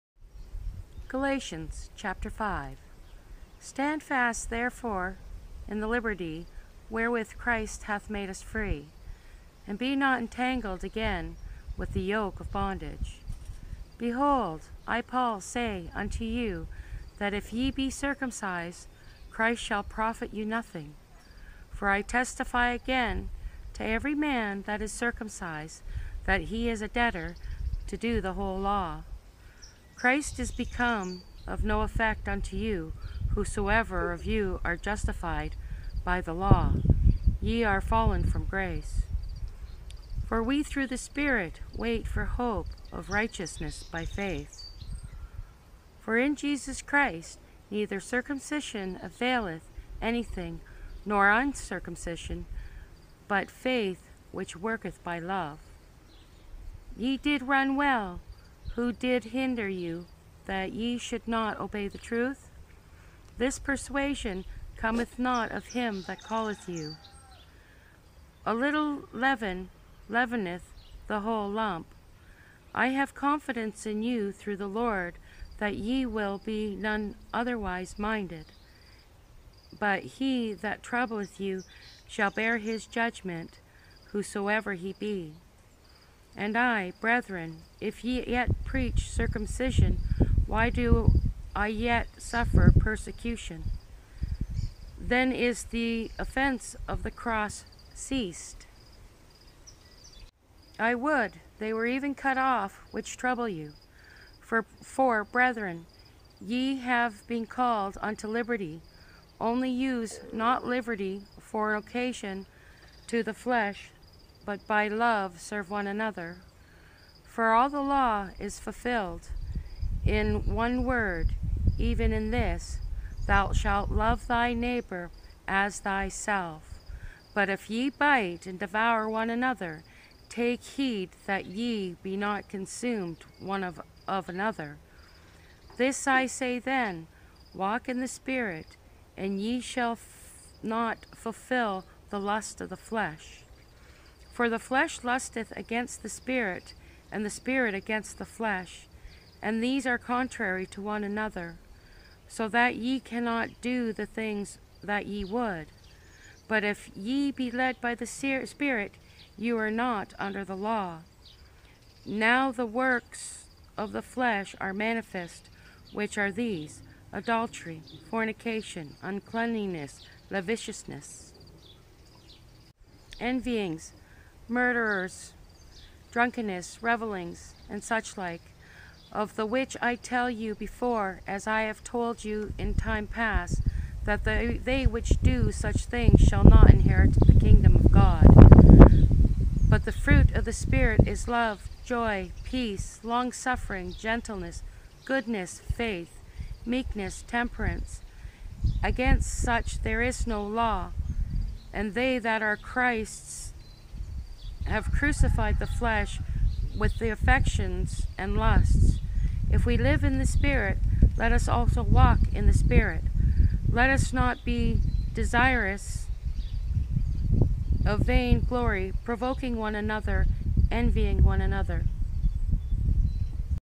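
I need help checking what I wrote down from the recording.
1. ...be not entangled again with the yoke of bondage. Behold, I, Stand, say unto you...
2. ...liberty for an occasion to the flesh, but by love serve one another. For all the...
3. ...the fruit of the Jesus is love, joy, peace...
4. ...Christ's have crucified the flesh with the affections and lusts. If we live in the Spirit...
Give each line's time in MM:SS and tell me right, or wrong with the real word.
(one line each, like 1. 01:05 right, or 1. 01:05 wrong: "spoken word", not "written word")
1. 00:09 wrong: "Paul", not "Stand"
2. 01:50 right
3. 03:09 wrong: "Spirit", not "Jesus"
4. 03:22 right.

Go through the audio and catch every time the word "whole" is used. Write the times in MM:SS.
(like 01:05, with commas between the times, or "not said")
00:28, 01:11.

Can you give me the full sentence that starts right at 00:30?
Christ is become of no effect unto you, whosoever of you are justified by the law.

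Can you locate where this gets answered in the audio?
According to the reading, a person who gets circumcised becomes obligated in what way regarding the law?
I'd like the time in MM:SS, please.
00:26.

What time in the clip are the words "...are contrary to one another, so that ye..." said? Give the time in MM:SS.
02:29.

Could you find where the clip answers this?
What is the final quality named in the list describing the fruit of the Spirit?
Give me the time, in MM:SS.
03:17.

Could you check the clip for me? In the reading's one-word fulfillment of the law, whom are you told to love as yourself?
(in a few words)
Thy neighbor.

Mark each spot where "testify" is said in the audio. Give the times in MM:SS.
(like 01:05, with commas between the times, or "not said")
00:22.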